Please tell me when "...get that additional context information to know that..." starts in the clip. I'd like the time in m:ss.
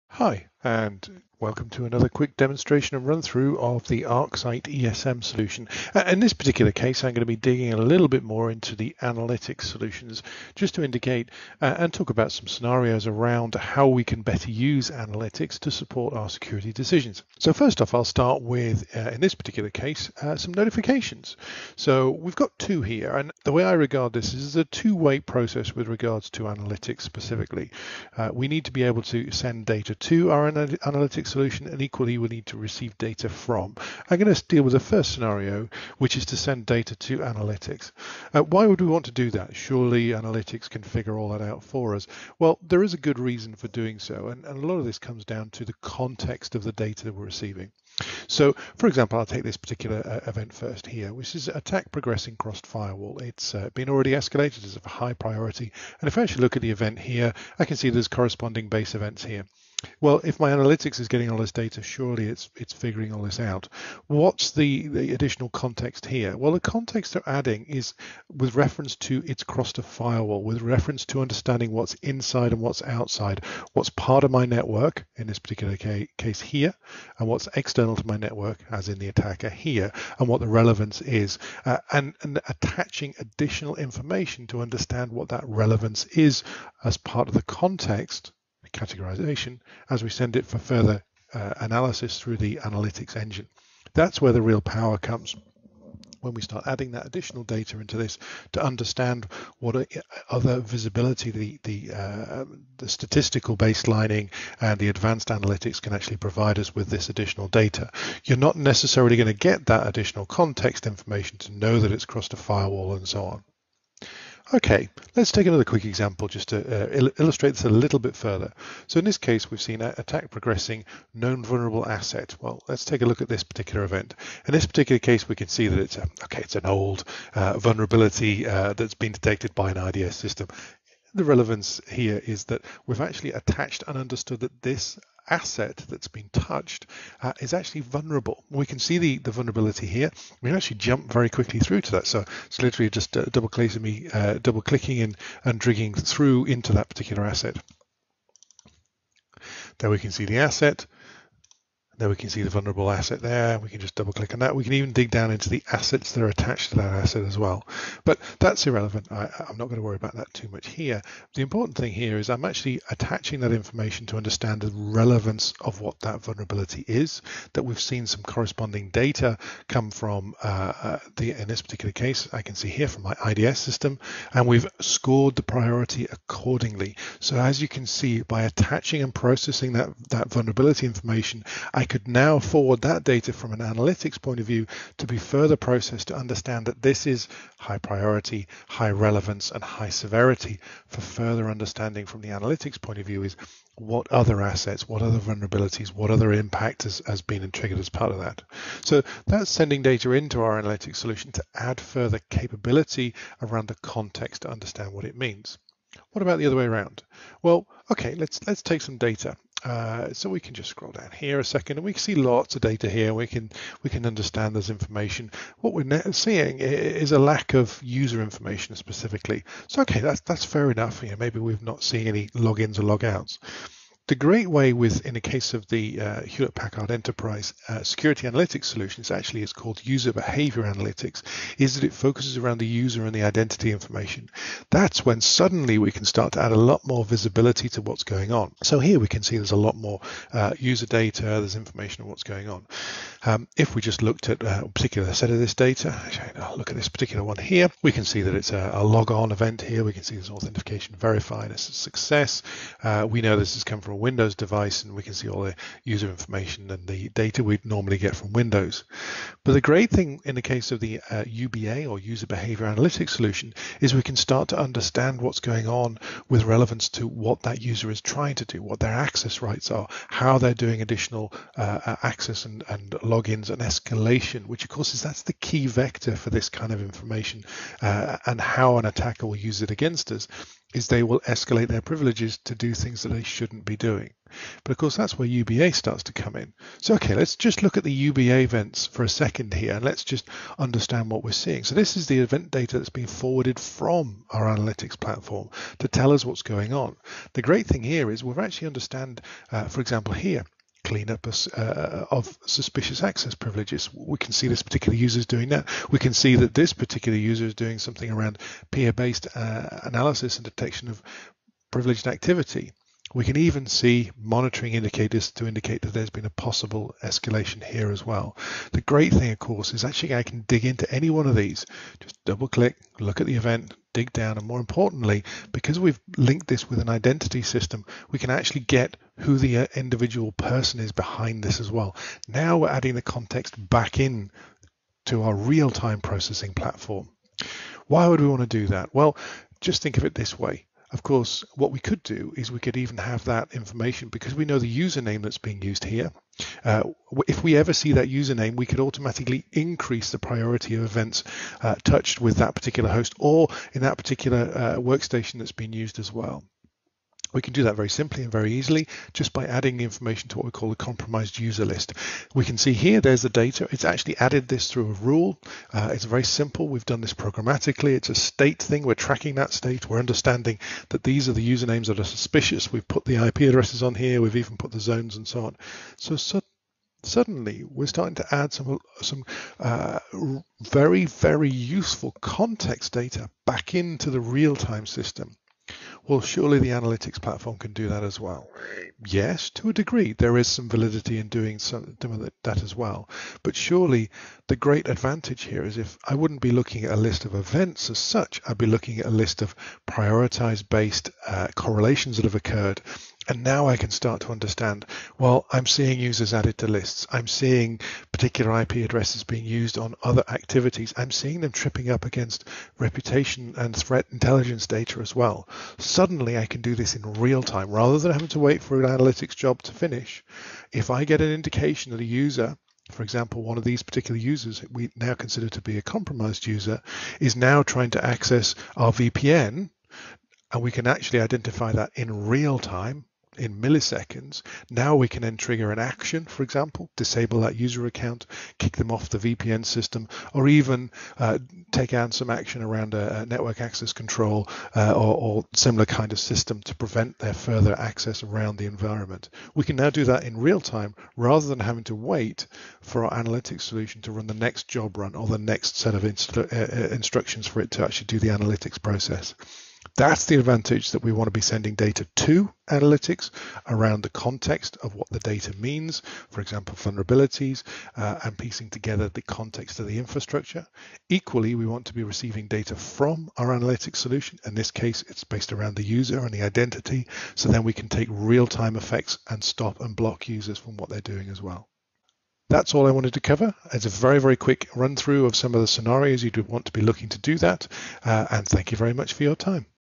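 1:49.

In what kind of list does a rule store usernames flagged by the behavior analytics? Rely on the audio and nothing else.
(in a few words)
compromised user list.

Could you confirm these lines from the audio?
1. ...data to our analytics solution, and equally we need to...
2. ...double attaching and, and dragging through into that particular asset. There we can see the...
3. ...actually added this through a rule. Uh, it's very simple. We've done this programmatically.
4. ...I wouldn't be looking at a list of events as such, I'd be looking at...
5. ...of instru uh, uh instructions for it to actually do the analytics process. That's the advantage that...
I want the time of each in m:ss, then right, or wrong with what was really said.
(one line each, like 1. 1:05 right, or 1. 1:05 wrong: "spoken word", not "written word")
1. 0:29 right
2. 2:24 wrong: "clicking", not "attaching"
3. 6:03 right
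4. 6:36 right
5. 7:35 right.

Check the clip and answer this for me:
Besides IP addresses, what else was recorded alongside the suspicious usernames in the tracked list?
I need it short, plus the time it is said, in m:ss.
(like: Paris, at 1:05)
zones, at 6:14.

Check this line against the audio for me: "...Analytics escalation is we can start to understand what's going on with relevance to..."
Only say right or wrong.
wrong.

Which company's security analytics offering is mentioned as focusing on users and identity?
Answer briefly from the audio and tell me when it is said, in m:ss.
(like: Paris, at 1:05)
Hewlett Packard Enterprise, at 3:46.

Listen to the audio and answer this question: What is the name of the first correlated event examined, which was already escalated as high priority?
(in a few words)
attack progressing crossed firewall.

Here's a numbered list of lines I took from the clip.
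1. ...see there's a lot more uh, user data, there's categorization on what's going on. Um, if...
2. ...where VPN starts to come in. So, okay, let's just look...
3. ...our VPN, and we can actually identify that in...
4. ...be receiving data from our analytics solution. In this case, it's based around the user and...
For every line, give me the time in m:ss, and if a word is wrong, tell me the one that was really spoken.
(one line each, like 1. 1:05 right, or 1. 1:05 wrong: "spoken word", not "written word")
1. 3:59 wrong: "information", not "categorization"
2. 4:45 wrong: "UBA", not "VPN"
3. 7:08 right
4. 7:51 right.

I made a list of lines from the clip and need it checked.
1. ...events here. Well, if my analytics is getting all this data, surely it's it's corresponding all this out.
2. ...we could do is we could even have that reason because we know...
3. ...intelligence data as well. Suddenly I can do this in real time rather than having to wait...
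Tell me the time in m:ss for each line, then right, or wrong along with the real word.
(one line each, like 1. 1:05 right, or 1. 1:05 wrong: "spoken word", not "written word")
1. 0:58 wrong: "figuring", not "corresponding"
2. 5:41 wrong: "information", not "reason"
3. 6:54 right.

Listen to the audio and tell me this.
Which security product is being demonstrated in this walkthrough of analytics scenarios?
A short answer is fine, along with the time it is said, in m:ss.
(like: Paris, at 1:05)
ArcSight ESM, at 0:04.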